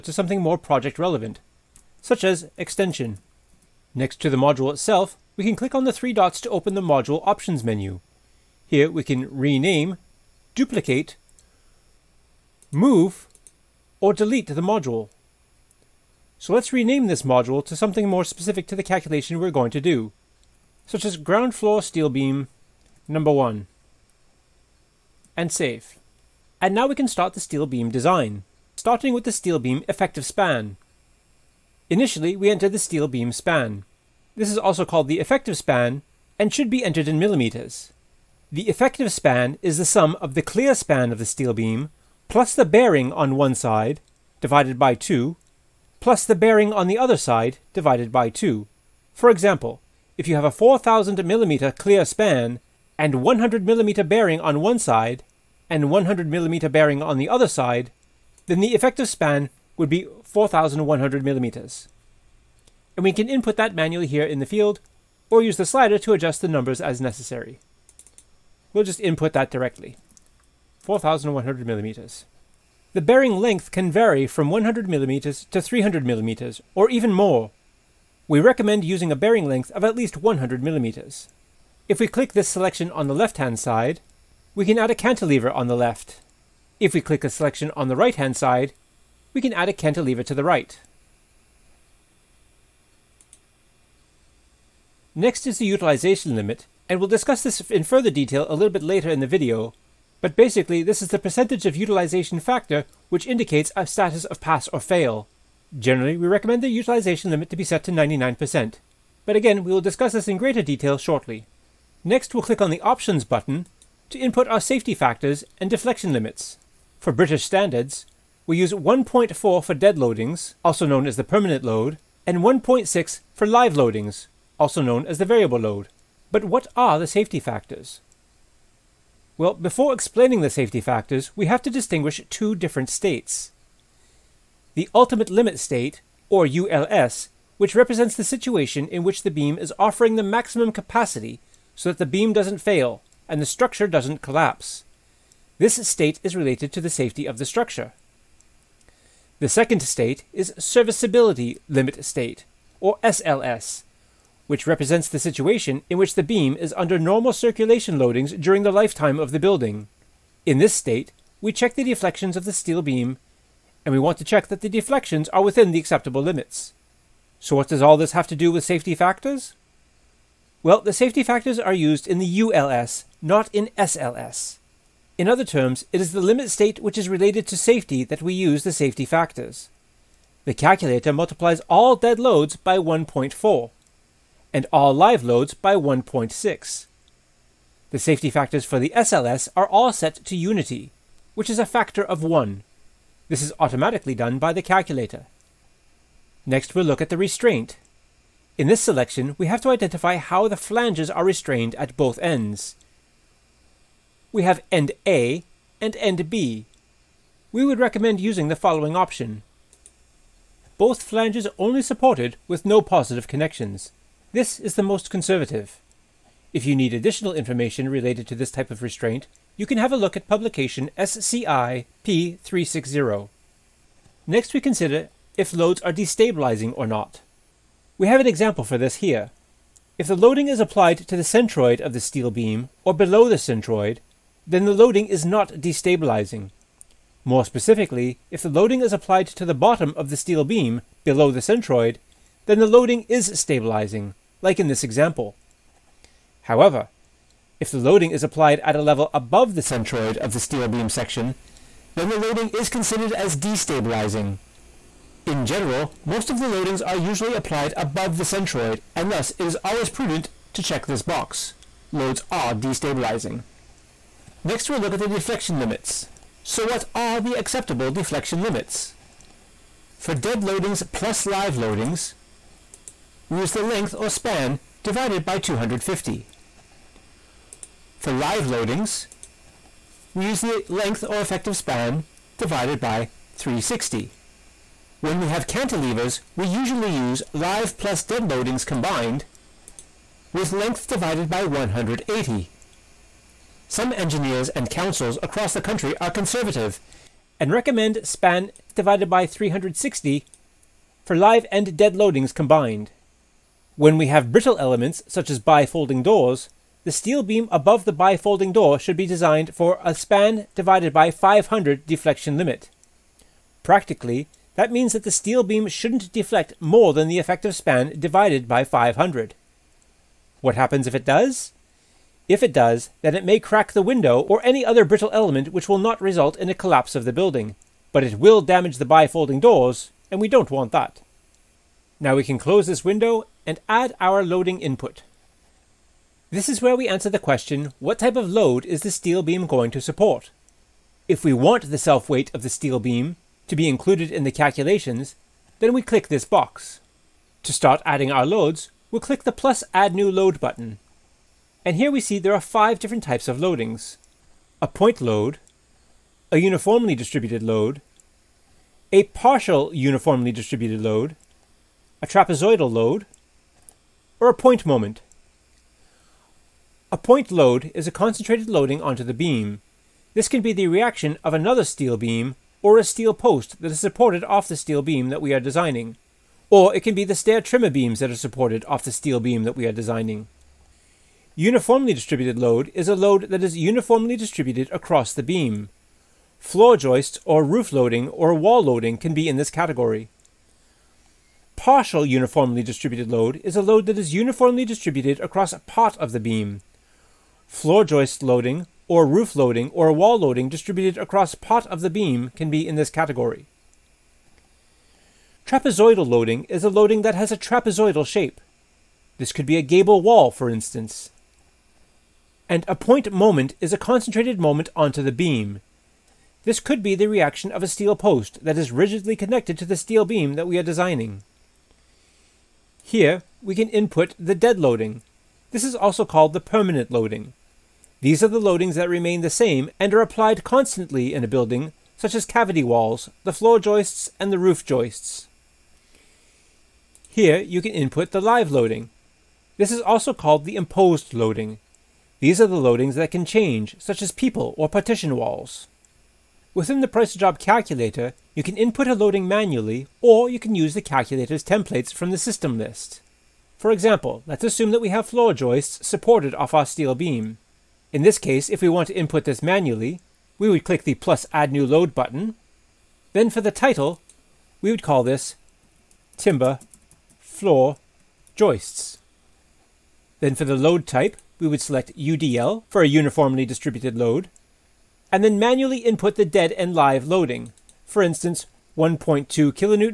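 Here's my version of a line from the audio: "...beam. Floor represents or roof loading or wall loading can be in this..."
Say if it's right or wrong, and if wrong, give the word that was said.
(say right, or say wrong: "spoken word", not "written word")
wrong: "joists", not "represents".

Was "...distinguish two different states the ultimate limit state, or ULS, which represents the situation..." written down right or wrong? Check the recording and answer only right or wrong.
right.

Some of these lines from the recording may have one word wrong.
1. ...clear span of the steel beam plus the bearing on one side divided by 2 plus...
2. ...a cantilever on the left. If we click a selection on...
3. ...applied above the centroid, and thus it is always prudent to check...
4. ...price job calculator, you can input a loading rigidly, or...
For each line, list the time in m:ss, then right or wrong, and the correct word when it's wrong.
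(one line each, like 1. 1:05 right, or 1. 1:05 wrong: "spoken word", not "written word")
1. 0:40 right
2. 1:24 right
3. 4:17 right
4. 7:26 wrong: "manually", not "rigidly".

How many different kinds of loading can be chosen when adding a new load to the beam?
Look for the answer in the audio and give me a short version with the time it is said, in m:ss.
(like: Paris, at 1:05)
five, at 5:52.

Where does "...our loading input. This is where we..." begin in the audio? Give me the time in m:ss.
5:33.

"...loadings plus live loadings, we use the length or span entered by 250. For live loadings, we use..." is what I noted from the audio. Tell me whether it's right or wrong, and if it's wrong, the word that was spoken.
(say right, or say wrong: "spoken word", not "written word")
wrong: "divided", not "entered".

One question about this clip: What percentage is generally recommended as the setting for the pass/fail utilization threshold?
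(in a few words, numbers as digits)
99%.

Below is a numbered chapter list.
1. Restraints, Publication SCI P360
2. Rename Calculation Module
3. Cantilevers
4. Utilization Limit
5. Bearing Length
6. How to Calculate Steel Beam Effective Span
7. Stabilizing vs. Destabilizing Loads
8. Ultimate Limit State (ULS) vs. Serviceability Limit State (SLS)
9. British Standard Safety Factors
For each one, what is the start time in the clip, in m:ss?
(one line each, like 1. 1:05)
1. 3:13
2. 0:18
3. 1:23
4. 1:33
5. 1:13
6. 0:28
7. 3:43
8. 2:13
9. 1:53.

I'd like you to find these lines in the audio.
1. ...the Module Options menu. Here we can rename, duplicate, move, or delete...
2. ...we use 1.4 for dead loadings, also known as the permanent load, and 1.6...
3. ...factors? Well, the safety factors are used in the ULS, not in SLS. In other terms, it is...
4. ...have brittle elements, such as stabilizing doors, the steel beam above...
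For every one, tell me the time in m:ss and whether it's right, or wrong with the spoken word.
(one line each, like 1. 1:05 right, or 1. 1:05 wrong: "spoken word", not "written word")
1. 0:06 right
2. 1:58 right
3. 2:48 right
4. 5:04 wrong: "bifolding", not "stabilizing".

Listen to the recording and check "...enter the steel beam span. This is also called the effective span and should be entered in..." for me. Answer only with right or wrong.
right.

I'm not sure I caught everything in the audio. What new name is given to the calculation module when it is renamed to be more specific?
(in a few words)
ground floor steel beam number one.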